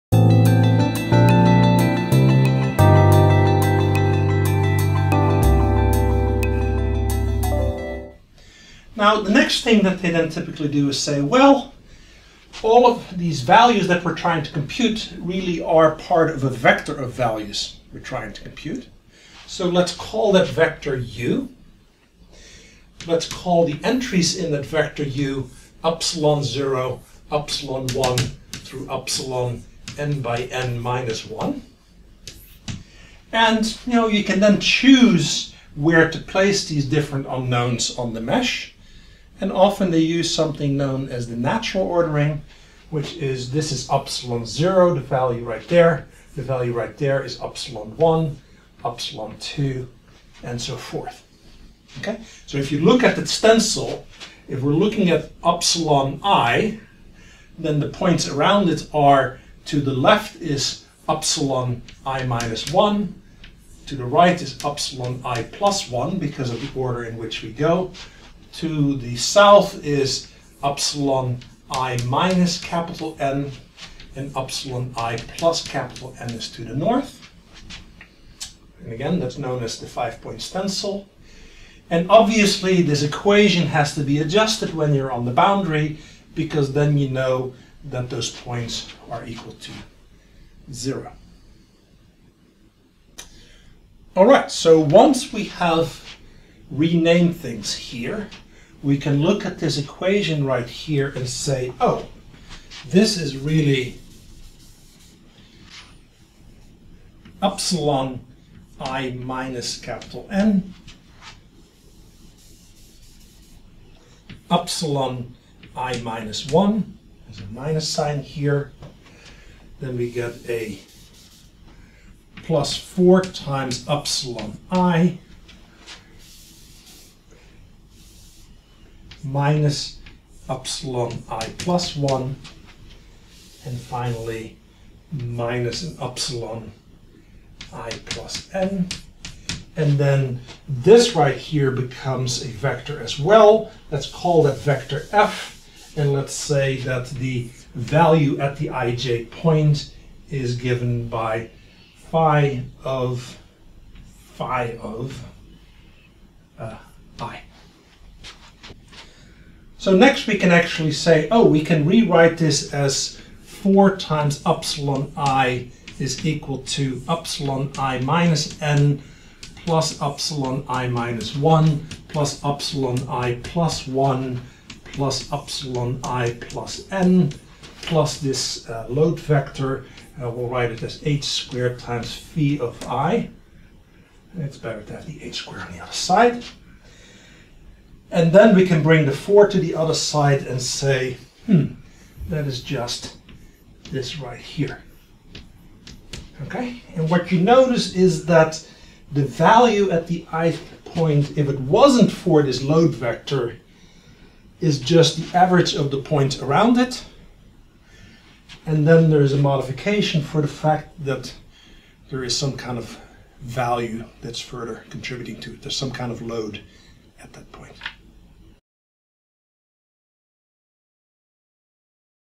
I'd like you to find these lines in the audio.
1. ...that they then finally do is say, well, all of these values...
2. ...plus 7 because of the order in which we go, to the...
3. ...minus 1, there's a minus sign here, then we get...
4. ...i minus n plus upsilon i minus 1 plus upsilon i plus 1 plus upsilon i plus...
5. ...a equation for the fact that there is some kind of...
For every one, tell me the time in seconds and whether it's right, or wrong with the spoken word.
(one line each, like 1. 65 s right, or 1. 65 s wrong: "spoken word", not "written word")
1. 9 s wrong: "typically", not "finally"
2. 65 s wrong: "1", not "7"
3. 116 s right
4. 167 s right
5. 209 s wrong: "modification", not "equation".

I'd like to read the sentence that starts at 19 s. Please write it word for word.
So let's call that vector u.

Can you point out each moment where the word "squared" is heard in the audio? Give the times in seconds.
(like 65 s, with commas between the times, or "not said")
181 s, 185 s.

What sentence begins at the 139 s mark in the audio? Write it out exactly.
And then this right here becomes a vector as well.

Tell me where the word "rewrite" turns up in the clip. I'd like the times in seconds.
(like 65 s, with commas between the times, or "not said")
161 s.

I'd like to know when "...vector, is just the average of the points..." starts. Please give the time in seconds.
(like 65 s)
202 s.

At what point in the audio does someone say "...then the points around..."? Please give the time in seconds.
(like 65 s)
57 s.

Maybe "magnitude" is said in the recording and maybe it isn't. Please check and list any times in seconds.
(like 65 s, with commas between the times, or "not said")
not said.